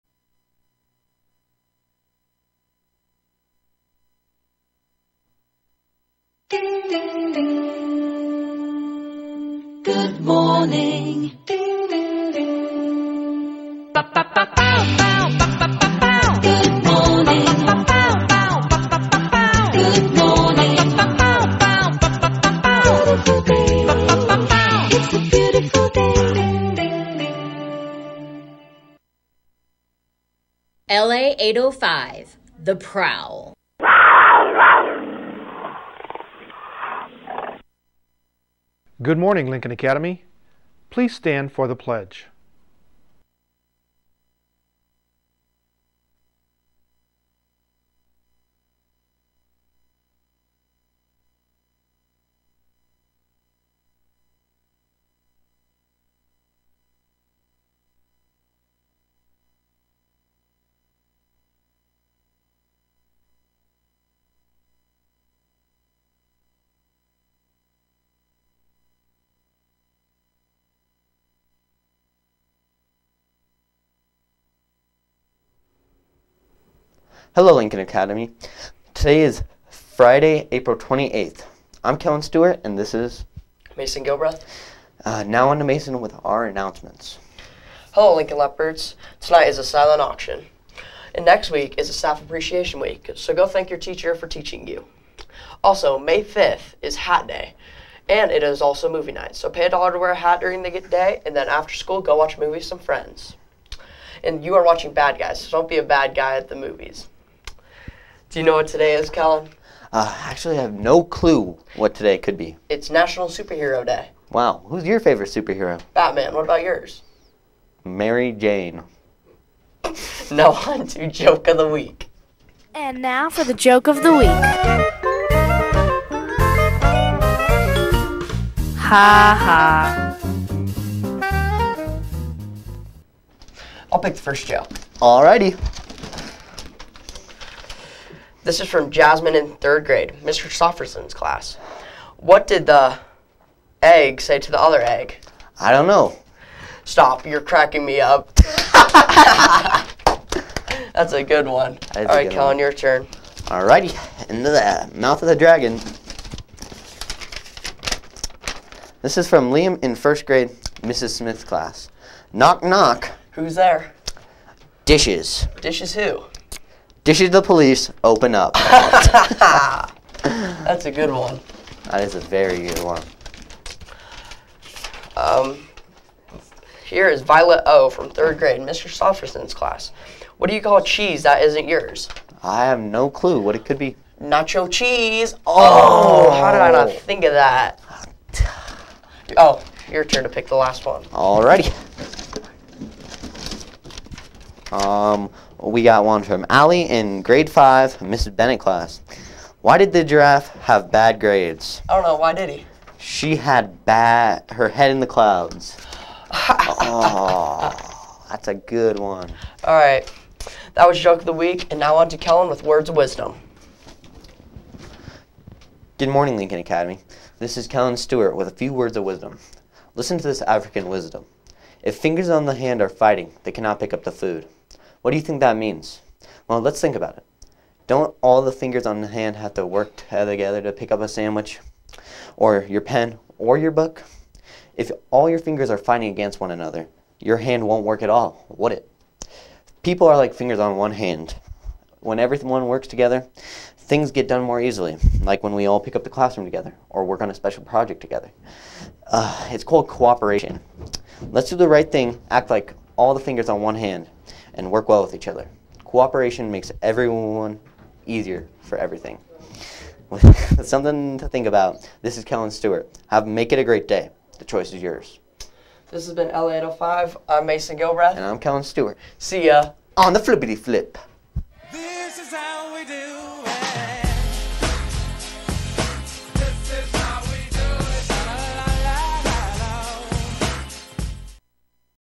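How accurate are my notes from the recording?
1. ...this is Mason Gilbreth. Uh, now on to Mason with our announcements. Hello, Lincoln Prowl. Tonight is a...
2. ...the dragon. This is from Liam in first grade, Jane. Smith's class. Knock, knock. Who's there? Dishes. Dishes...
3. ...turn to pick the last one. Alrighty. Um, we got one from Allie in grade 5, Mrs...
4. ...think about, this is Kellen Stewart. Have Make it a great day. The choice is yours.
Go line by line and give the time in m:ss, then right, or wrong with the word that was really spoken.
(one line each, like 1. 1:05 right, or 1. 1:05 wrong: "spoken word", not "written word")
1. 1:22 wrong: "Leopards", not "Prowl"
2. 2:35 wrong: "Mrs", not "Jane"
3. 3:10 right
4. 4:21 right.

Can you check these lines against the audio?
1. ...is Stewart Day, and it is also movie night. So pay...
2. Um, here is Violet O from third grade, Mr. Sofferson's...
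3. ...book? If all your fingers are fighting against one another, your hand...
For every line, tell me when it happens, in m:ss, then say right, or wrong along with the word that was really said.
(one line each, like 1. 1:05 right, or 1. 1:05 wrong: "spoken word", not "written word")
1. 1:36 wrong: "Hat", not "Stewart"
2. 2:55 right
3. 3:53 right.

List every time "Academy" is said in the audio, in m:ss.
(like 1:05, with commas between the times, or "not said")
0:39, 1:17, 3:36.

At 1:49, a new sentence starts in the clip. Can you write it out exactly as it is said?
Uh, actually, I have no clue what today could be.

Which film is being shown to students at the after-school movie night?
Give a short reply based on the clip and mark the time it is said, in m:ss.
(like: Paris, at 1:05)
Bad Guys, at 1:44.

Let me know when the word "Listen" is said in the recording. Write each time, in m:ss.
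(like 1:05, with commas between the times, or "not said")
3:39.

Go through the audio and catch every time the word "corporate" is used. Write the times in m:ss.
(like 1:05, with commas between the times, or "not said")
not said.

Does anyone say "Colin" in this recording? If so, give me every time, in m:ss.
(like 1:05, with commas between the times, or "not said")
1:49, 2:32.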